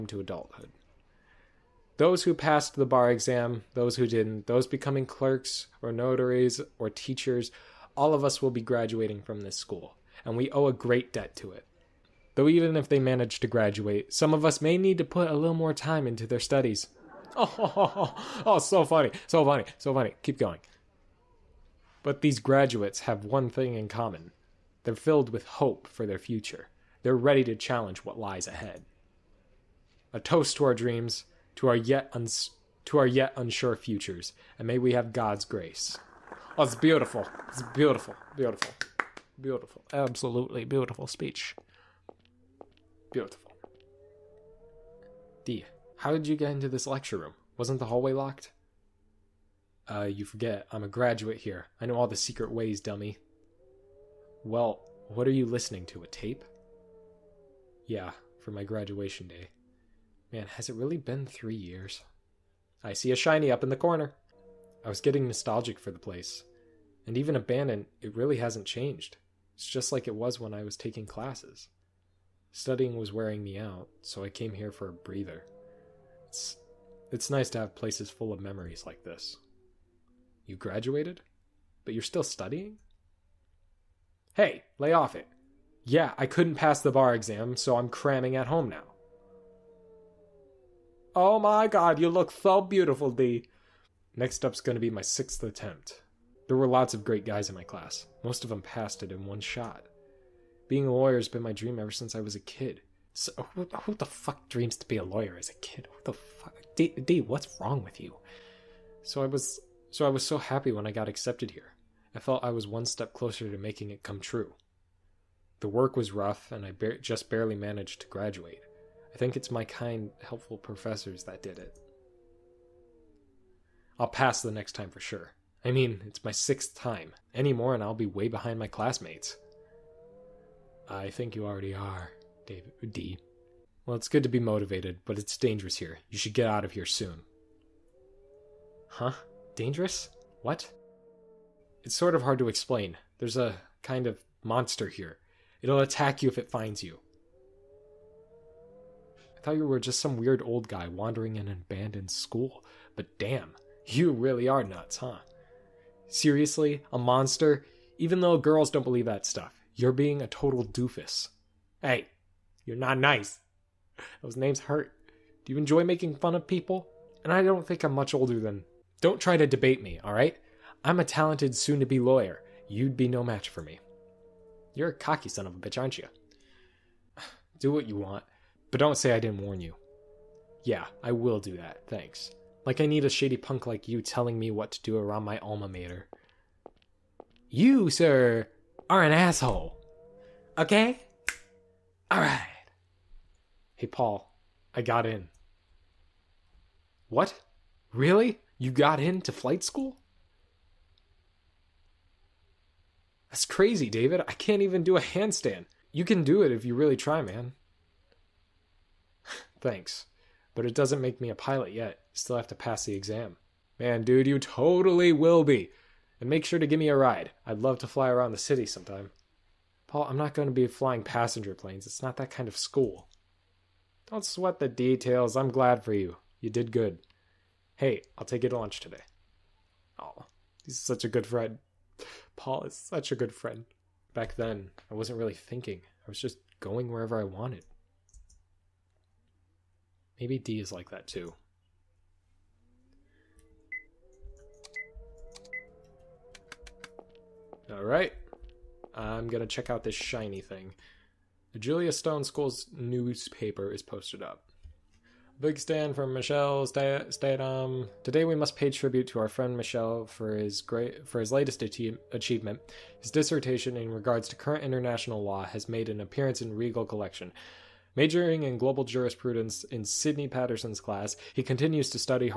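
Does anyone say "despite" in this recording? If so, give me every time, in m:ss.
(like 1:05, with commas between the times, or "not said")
not said.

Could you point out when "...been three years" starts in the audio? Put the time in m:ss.
1:00.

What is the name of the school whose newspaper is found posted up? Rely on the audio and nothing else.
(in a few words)
Julius Stone School.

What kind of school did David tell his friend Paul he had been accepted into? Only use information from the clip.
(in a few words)
flight school.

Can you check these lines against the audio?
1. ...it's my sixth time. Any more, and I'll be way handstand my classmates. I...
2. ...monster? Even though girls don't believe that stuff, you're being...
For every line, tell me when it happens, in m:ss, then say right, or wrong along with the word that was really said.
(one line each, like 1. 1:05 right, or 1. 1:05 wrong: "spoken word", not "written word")
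1. 2:06 wrong: "behind", not "handstand"
2. 2:36 right.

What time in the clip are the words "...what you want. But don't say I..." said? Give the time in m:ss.
2:57.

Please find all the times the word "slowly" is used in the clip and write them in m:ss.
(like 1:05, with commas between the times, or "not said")
not said.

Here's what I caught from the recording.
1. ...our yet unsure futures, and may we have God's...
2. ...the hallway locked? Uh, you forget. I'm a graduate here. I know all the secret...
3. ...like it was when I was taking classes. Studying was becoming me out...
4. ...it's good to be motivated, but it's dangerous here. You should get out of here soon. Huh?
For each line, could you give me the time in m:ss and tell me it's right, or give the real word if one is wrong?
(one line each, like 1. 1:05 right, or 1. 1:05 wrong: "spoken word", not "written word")
1. 0:32 right
2. 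0:47 right
3. 1:09 wrong: "wearing", not "becoming"
4. 2:13 right.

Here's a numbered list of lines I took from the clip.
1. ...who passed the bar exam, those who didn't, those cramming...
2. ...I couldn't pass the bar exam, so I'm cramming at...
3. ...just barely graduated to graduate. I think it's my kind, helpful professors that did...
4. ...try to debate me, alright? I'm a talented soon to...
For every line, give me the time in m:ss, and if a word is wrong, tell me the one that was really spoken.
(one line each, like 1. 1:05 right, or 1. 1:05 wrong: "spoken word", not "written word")
1. 0:02 wrong: "becoming", not "cramming"
2. 1:26 right
3. 1:56 wrong: "managed", not "graduated"
4. 2:49 right.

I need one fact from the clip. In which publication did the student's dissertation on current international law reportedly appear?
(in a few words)
Regal Collection.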